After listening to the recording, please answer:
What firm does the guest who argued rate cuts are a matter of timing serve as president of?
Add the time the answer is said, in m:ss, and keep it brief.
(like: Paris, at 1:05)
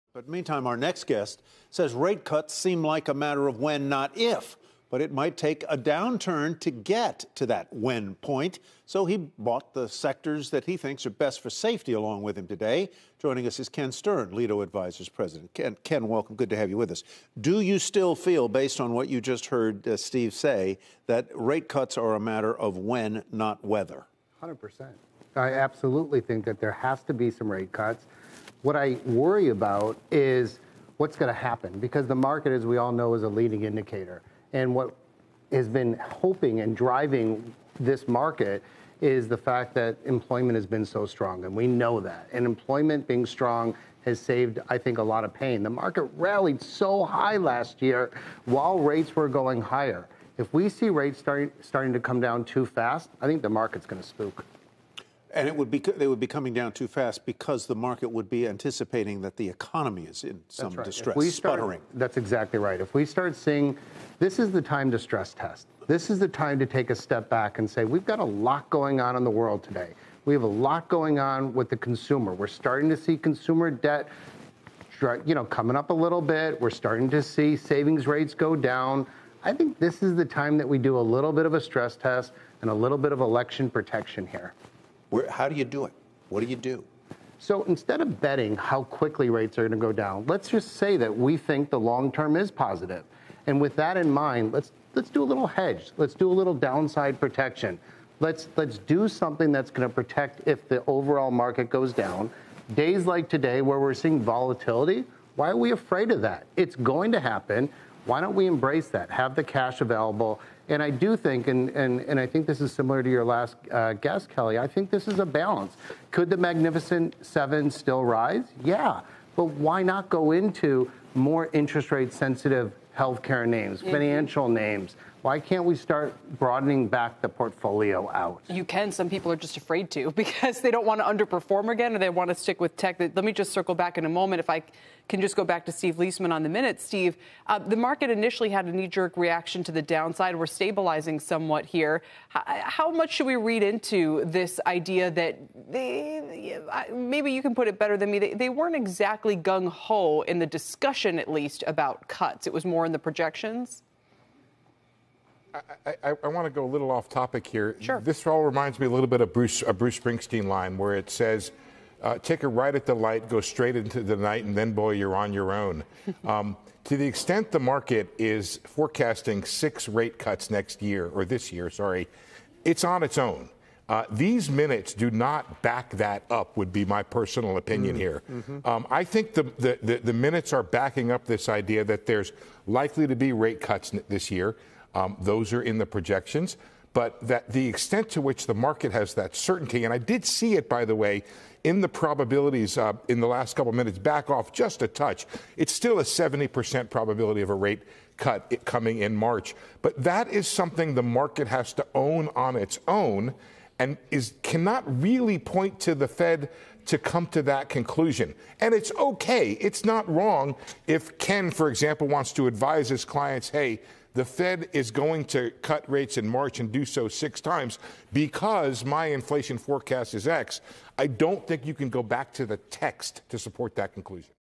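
Lido Advisors, at 0:14.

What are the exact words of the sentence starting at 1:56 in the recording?
Could the Magnificent Seven still rise?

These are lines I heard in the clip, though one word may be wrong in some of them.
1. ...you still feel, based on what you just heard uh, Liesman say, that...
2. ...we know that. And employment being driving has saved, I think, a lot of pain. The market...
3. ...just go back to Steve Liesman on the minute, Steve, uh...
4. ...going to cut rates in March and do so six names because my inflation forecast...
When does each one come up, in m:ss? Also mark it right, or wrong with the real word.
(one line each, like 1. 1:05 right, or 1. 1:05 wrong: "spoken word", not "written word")
1. 0:17 wrong: "Steve", not "Liesman"
2. 0:41 wrong: "strong", not "driving"
3. 2:15 right
4. 3:34 wrong: "times", not "names".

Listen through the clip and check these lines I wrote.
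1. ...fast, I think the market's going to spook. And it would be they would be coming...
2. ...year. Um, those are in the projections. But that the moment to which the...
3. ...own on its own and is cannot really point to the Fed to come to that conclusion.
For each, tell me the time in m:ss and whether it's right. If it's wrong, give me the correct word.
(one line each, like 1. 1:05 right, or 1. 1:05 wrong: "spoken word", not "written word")
1. 0:52 right
2. 3:04 wrong: "extent", not "moment"
3. 3:21 right.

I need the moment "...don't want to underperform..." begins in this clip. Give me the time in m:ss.
2:10.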